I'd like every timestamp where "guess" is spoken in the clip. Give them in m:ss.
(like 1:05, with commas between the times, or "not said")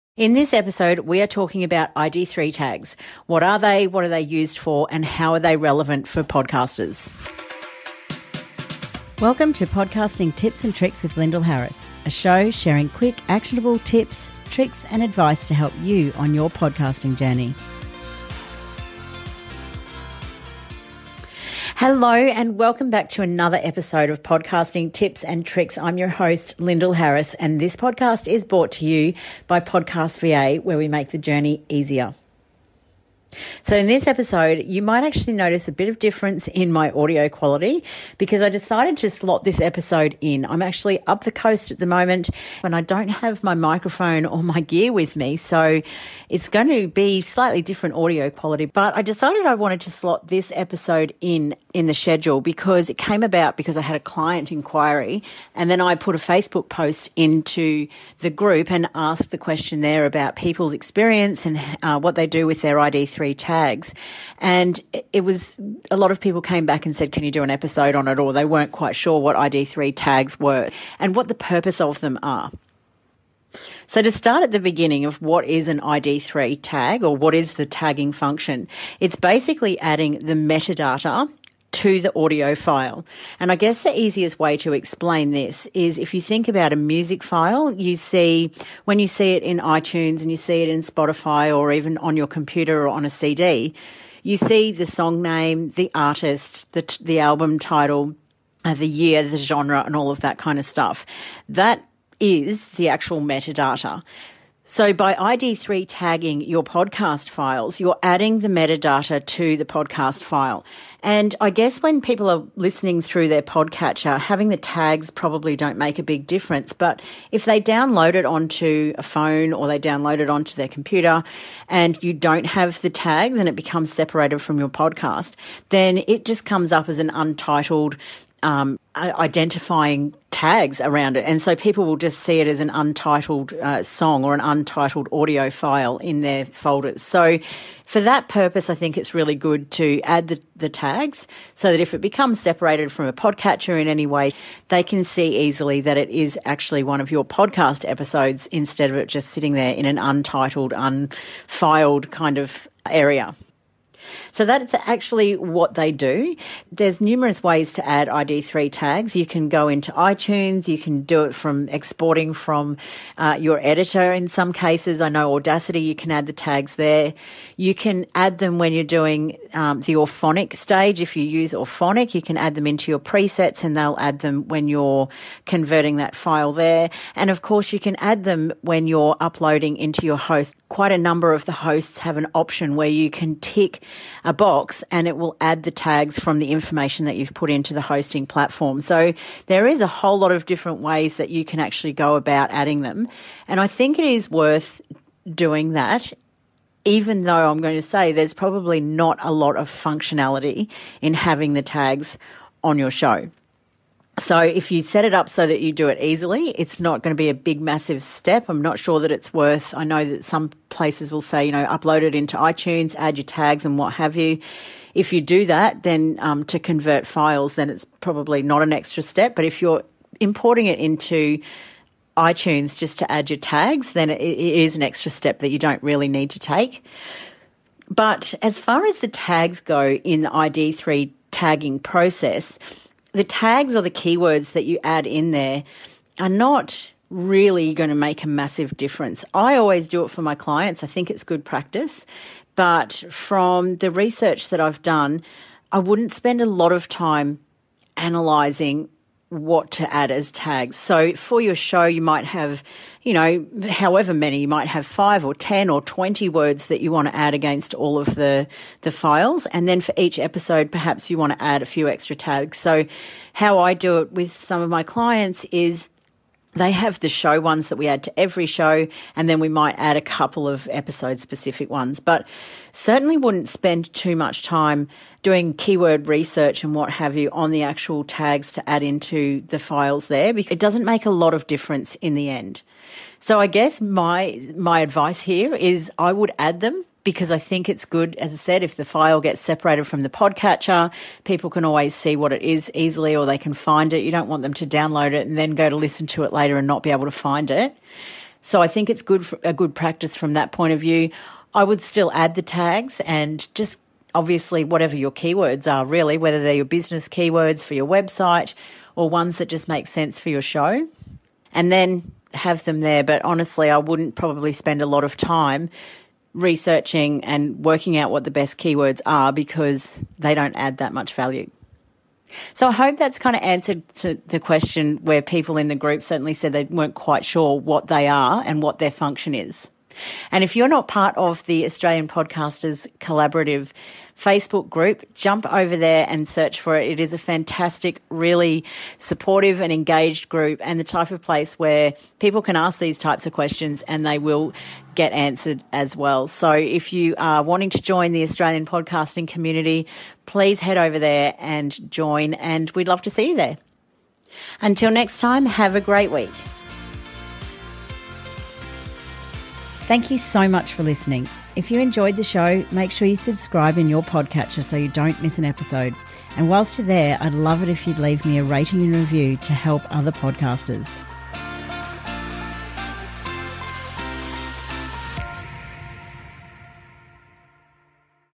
1:23, 1:51, 4:43.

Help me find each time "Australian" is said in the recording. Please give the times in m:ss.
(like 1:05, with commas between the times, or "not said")
5:31, 5:48.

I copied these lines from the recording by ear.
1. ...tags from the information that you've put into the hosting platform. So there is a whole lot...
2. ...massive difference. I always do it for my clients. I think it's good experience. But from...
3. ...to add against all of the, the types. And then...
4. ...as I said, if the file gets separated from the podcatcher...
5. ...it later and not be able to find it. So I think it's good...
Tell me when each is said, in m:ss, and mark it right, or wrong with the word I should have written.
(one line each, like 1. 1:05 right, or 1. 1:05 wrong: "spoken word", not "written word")
1. 3:05 right
2. 3:58 wrong: "practice", not "experience"
3. 4:17 wrong: "files", not "types"
4. 4:48 right
5. 4:56 right.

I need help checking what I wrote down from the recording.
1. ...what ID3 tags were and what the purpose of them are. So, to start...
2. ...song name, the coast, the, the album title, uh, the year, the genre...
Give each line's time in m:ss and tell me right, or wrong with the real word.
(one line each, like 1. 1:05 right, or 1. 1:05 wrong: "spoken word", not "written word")
1. 1:09 right
2. 1:34 wrong: "artist", not "coast".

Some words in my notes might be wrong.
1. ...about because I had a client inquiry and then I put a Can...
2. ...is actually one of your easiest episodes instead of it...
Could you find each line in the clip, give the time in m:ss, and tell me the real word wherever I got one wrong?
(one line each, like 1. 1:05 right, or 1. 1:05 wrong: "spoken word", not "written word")
1. 0:53 wrong: "Facebook", not "Can"
2. 2:26 wrong: "podcast", not "easiest".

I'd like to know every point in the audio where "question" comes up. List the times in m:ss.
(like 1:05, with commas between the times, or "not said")
0:59, 5:24, 5:43.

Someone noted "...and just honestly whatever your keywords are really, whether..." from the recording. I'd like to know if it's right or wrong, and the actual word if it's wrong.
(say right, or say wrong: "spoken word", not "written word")
wrong: "obviously", not "honestly".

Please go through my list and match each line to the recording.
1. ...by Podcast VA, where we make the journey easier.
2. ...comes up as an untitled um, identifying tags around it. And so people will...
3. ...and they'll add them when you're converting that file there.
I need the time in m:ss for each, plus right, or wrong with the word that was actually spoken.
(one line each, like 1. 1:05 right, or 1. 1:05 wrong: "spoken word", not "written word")
1. 0:29 right
2. 2:06 right
3. 2:53 right.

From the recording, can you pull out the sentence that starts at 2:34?
So that's actually what they do.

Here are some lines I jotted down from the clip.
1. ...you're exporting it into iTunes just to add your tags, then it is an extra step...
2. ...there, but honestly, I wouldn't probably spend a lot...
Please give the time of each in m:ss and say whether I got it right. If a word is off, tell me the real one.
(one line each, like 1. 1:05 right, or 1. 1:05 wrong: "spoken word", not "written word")
1. 3:39 wrong: "importing", not "exporting"
2. 5:12 right.